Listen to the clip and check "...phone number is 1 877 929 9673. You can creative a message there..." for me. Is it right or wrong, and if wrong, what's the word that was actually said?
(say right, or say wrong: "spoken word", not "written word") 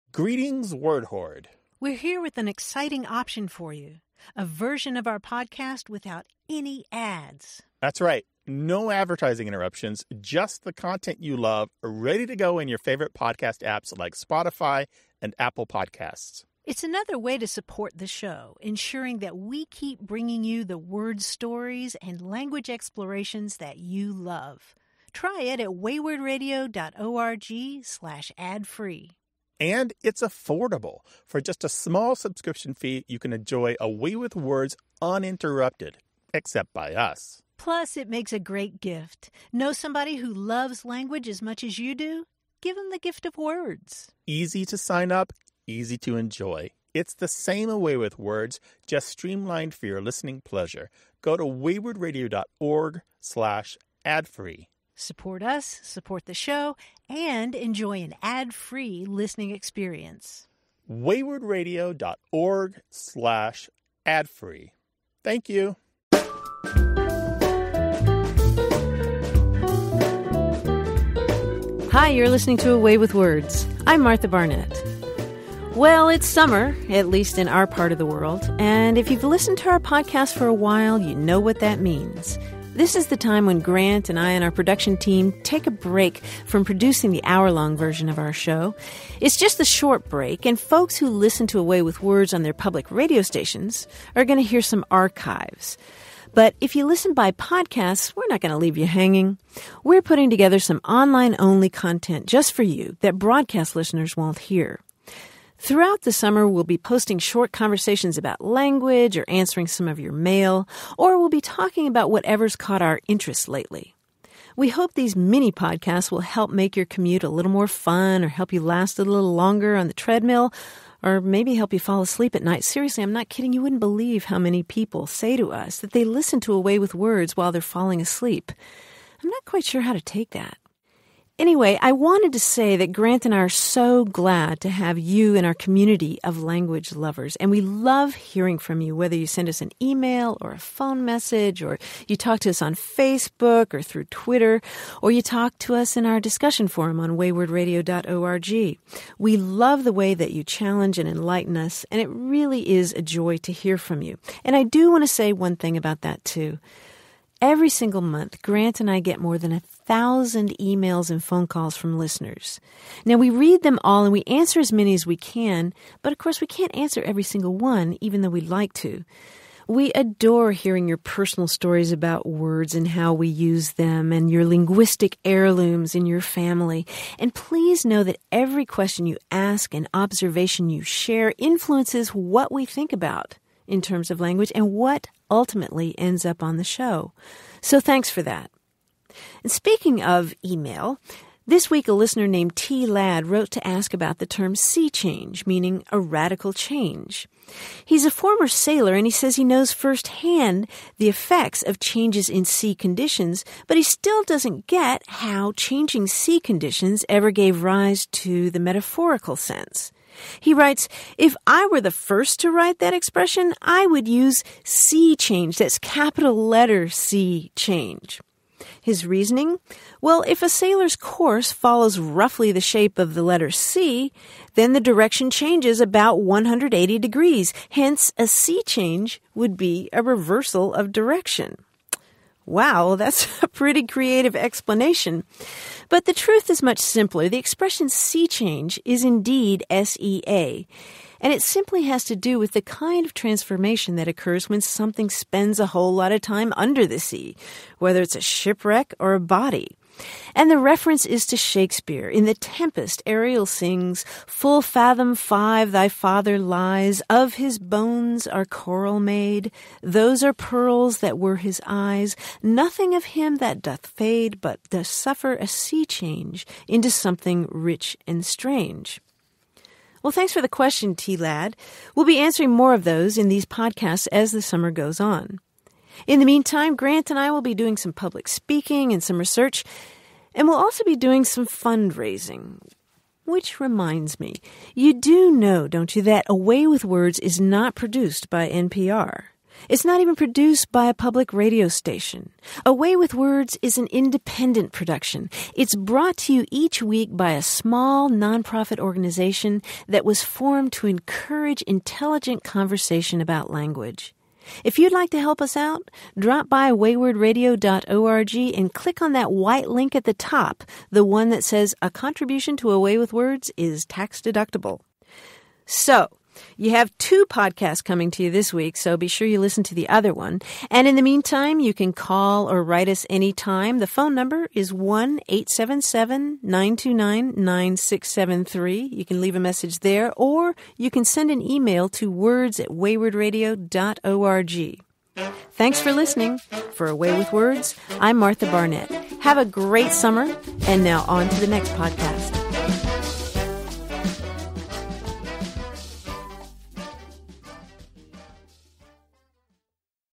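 wrong: "leave", not "creative".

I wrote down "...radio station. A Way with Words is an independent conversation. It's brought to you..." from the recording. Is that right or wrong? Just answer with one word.
wrong.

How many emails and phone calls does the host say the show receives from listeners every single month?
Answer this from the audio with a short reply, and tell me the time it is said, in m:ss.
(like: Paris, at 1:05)
more than 1,000, at 2:39.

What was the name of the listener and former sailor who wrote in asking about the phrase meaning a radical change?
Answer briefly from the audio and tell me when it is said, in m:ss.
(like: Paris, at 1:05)
T. Ladd, at 3:12.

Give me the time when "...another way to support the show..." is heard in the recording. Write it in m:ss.
0:16.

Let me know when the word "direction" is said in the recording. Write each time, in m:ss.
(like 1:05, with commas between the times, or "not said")
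3:44, 3:50.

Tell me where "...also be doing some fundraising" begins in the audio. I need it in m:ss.
4:40.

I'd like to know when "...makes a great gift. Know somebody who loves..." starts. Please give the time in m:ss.
0:38.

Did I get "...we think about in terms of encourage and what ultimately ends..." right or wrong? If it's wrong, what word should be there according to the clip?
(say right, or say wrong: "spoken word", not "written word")
wrong: "language", not "encourage".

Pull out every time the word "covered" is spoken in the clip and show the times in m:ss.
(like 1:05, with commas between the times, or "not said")
not said.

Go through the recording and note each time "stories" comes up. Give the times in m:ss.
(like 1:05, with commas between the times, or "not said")
0:21, 2:51.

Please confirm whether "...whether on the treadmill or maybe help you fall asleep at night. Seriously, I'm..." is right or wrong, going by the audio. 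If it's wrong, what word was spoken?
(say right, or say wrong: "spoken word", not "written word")
wrong: "longer", not "whether".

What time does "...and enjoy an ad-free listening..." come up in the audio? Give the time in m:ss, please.
0:57.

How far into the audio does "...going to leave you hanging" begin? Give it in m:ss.
1:38.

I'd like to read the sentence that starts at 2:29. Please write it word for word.
We love the way that you challenge and enlighten us, and it really is a joy to hear from you.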